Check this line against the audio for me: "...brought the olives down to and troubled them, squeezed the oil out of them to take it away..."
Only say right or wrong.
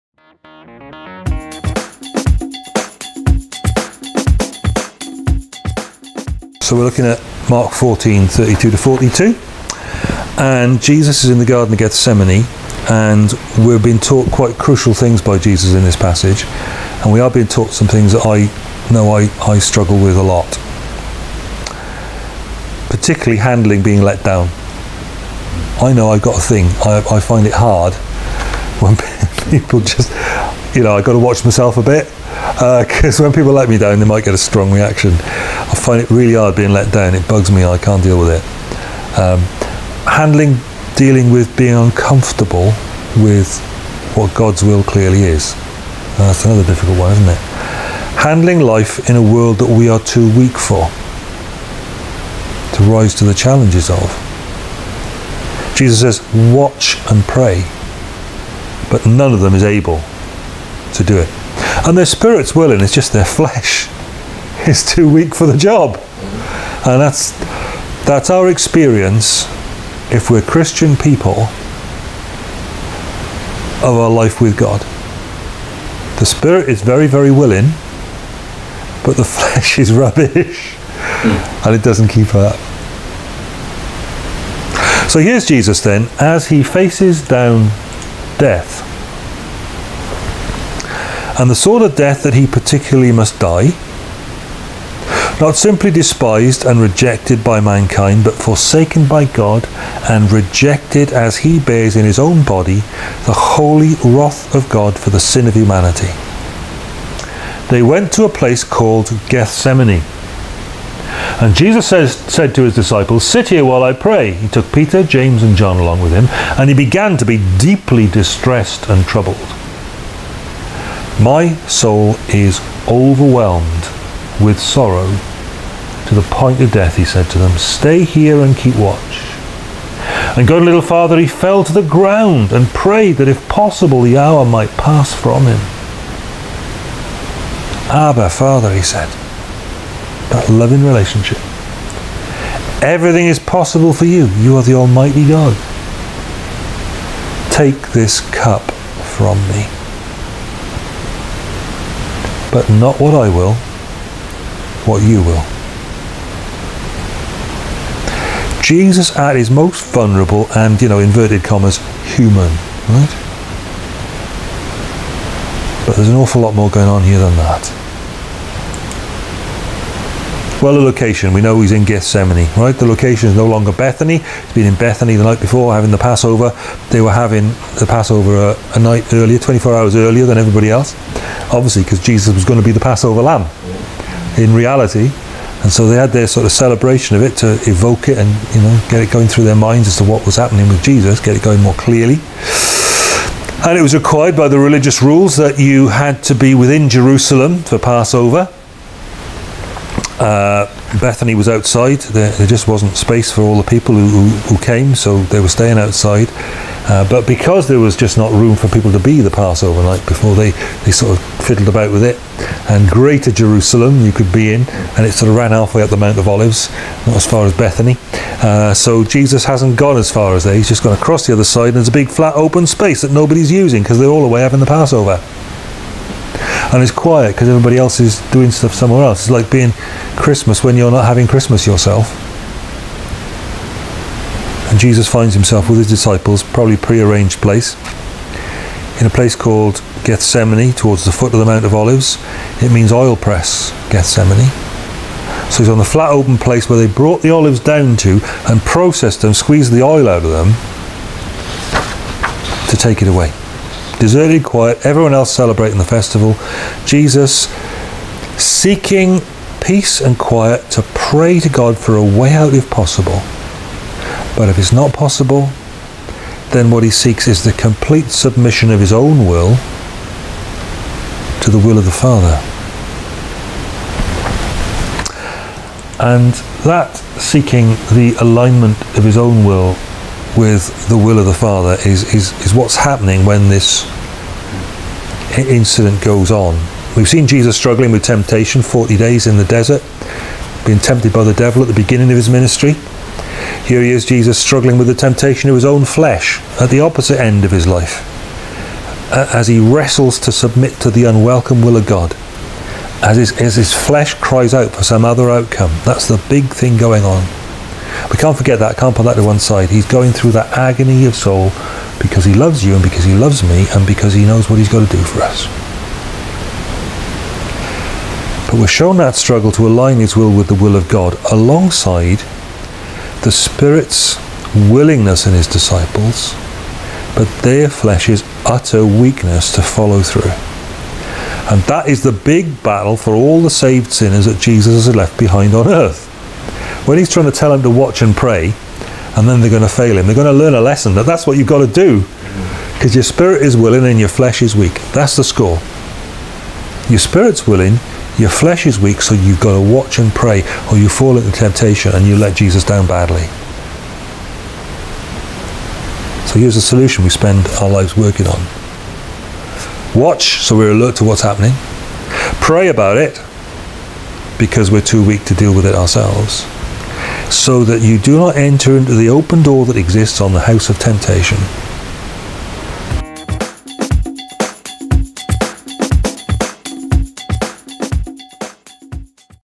wrong.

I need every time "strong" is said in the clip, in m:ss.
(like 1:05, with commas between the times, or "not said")
0:34.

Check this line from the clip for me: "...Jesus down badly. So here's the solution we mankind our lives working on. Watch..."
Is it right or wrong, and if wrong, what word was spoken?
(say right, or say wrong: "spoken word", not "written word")
wrong: "spend", not "mankind".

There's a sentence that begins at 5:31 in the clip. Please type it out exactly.
And that is the big battle for all the saved sinners that Jesus has left behind on earth.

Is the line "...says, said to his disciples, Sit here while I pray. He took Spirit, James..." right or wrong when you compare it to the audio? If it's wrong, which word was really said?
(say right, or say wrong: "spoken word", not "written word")
wrong: "Peter", not "Spirit".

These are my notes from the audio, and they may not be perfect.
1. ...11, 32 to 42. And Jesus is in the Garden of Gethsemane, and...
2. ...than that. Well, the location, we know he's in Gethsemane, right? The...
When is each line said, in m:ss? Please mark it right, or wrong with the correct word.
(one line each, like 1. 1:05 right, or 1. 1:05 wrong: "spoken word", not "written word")
1. 0:07 wrong: "14", not "11"
2. 2:47 right.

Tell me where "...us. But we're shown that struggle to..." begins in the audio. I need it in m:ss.
5:15.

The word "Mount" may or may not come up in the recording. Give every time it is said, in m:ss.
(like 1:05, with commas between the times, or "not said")
3:35, 4:01.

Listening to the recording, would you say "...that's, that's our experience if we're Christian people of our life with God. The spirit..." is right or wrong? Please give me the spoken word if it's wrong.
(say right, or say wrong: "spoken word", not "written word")
right.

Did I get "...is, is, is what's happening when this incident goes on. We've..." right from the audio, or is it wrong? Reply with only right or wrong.
right.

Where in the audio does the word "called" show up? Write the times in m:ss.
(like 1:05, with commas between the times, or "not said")
1:48, 3:59.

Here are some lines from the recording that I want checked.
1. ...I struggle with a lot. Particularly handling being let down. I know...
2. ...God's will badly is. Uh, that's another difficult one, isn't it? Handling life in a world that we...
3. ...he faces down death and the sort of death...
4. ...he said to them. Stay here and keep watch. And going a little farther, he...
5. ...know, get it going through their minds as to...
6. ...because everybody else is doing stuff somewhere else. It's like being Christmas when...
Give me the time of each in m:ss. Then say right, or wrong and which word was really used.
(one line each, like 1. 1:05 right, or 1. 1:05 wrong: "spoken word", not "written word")
1. 0:19 right
2. 0:44 wrong: "clearly", not "badly"
3. 1:26 right
4. 2:06 right
5. 3:08 right
6. 3:47 right.